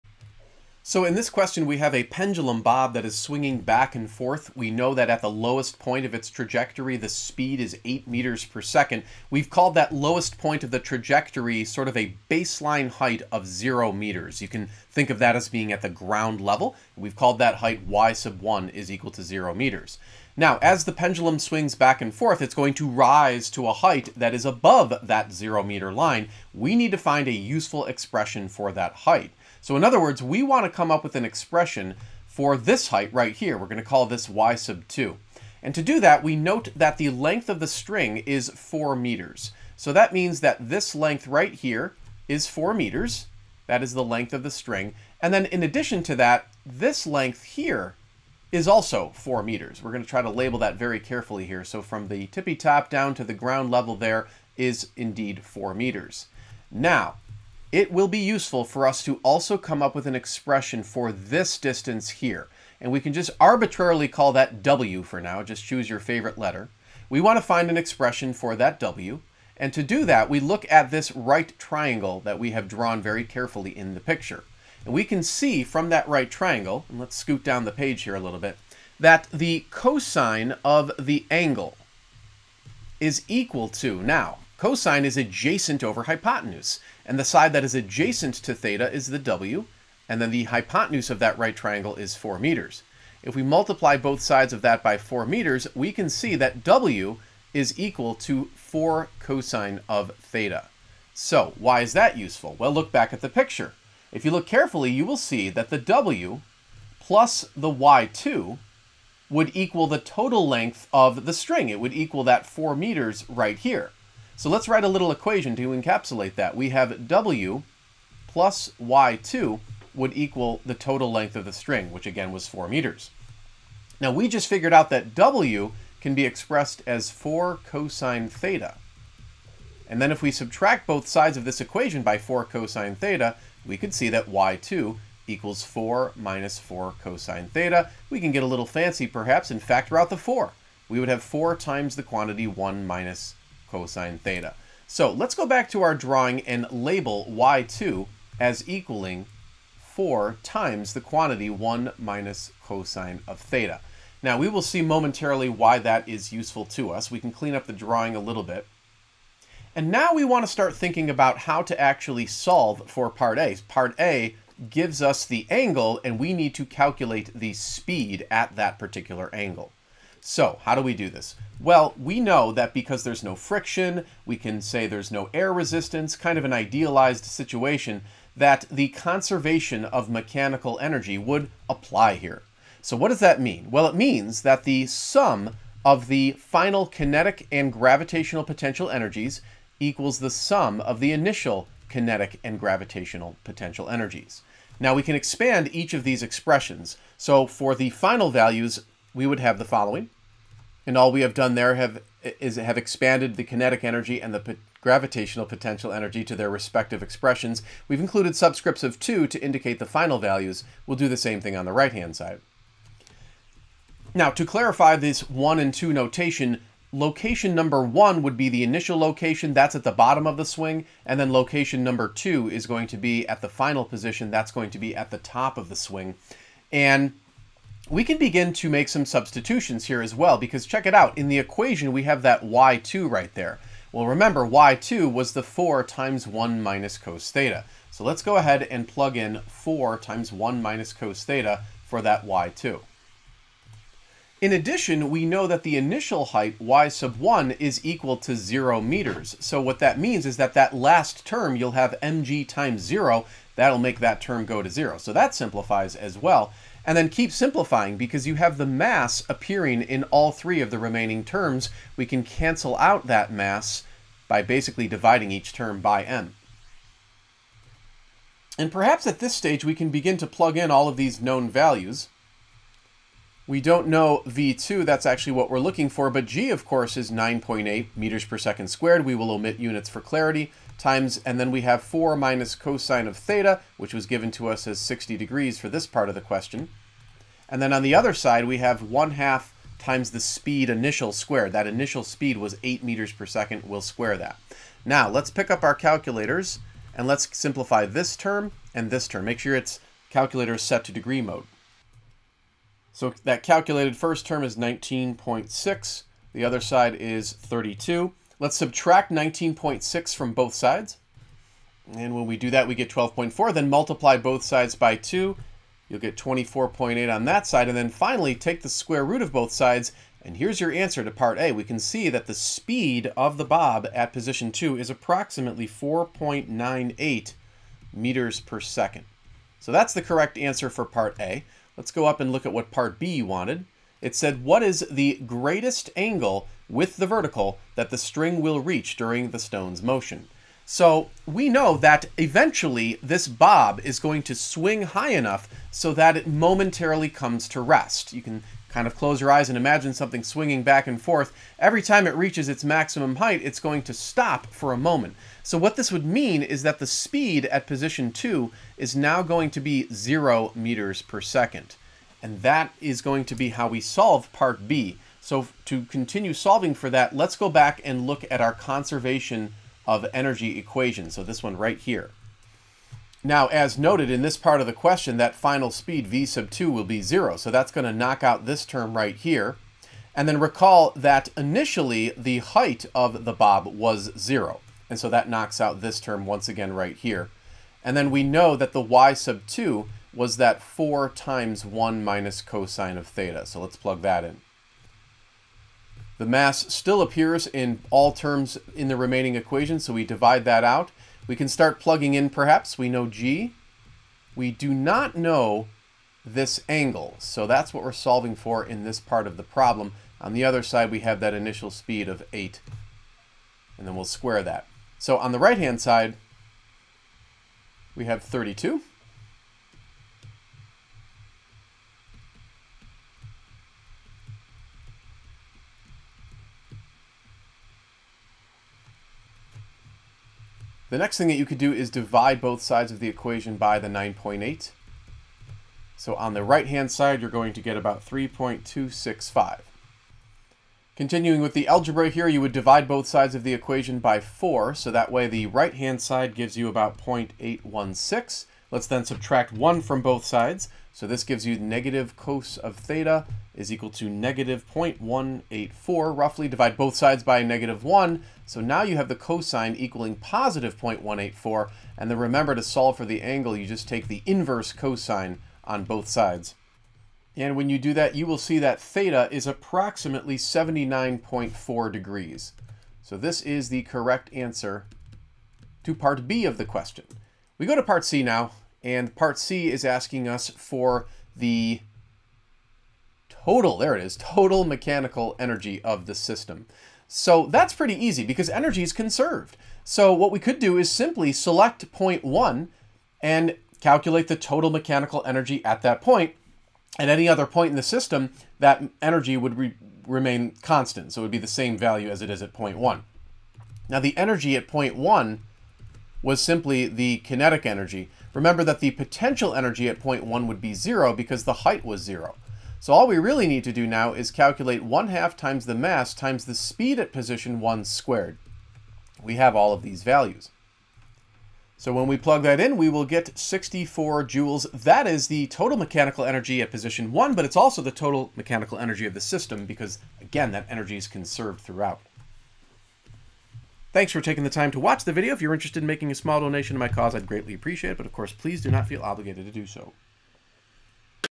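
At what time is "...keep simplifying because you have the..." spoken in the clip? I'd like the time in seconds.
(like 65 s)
257 s.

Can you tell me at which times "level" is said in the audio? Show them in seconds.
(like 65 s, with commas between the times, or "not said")
16 s, 53 s.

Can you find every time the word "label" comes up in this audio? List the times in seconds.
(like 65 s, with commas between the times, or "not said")
50 s, 146 s.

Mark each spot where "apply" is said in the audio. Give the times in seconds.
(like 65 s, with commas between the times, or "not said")
181 s.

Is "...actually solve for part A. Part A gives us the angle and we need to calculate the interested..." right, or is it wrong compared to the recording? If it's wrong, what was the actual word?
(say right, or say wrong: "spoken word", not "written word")
wrong: "speed", not "interested".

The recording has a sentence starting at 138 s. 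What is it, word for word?
We can get a little fancy perhaps and factor out the 4.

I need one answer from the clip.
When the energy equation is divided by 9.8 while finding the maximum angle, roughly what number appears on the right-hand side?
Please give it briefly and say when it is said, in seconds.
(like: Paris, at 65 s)
About 3.265, at 438 s.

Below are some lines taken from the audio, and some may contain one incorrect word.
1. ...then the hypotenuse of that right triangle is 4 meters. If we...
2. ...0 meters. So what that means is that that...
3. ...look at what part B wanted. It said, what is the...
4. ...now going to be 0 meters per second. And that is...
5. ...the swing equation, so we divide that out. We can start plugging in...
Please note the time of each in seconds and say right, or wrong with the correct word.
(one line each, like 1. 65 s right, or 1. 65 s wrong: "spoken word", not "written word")
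1. 90 s right
2. 248 s right
3. 332 s right
4. 358 s right
5. 398 s wrong: "remaining", not "swing".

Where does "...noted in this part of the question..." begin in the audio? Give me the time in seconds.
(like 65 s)
373 s.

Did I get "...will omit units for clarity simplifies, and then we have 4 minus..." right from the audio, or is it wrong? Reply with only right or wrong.
wrong.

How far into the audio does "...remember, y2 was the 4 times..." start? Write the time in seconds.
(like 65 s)
234 s.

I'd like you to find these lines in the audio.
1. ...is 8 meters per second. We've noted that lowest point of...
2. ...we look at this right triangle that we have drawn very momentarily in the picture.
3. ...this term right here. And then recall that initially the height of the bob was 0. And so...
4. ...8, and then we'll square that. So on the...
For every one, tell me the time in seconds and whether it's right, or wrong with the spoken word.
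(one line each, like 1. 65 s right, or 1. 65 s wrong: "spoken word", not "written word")
1. 7 s wrong: "called", not "noted"
2. 70 s wrong: "carefully", not "momentarily"
3. 378 s right
4. 412 s right.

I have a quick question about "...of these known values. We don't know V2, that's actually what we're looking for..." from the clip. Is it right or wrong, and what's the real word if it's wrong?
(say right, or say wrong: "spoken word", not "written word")
right.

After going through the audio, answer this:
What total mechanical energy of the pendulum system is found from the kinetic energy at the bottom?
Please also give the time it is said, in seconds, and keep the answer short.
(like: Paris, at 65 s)
64 joules, at 523 s.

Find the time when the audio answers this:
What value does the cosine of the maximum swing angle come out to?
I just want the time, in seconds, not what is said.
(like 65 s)
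460 s.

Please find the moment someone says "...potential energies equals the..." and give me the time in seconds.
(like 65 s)
188 s.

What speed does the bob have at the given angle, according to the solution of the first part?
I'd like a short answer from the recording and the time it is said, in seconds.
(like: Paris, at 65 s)
About 4.98 meters per second, at 325 s.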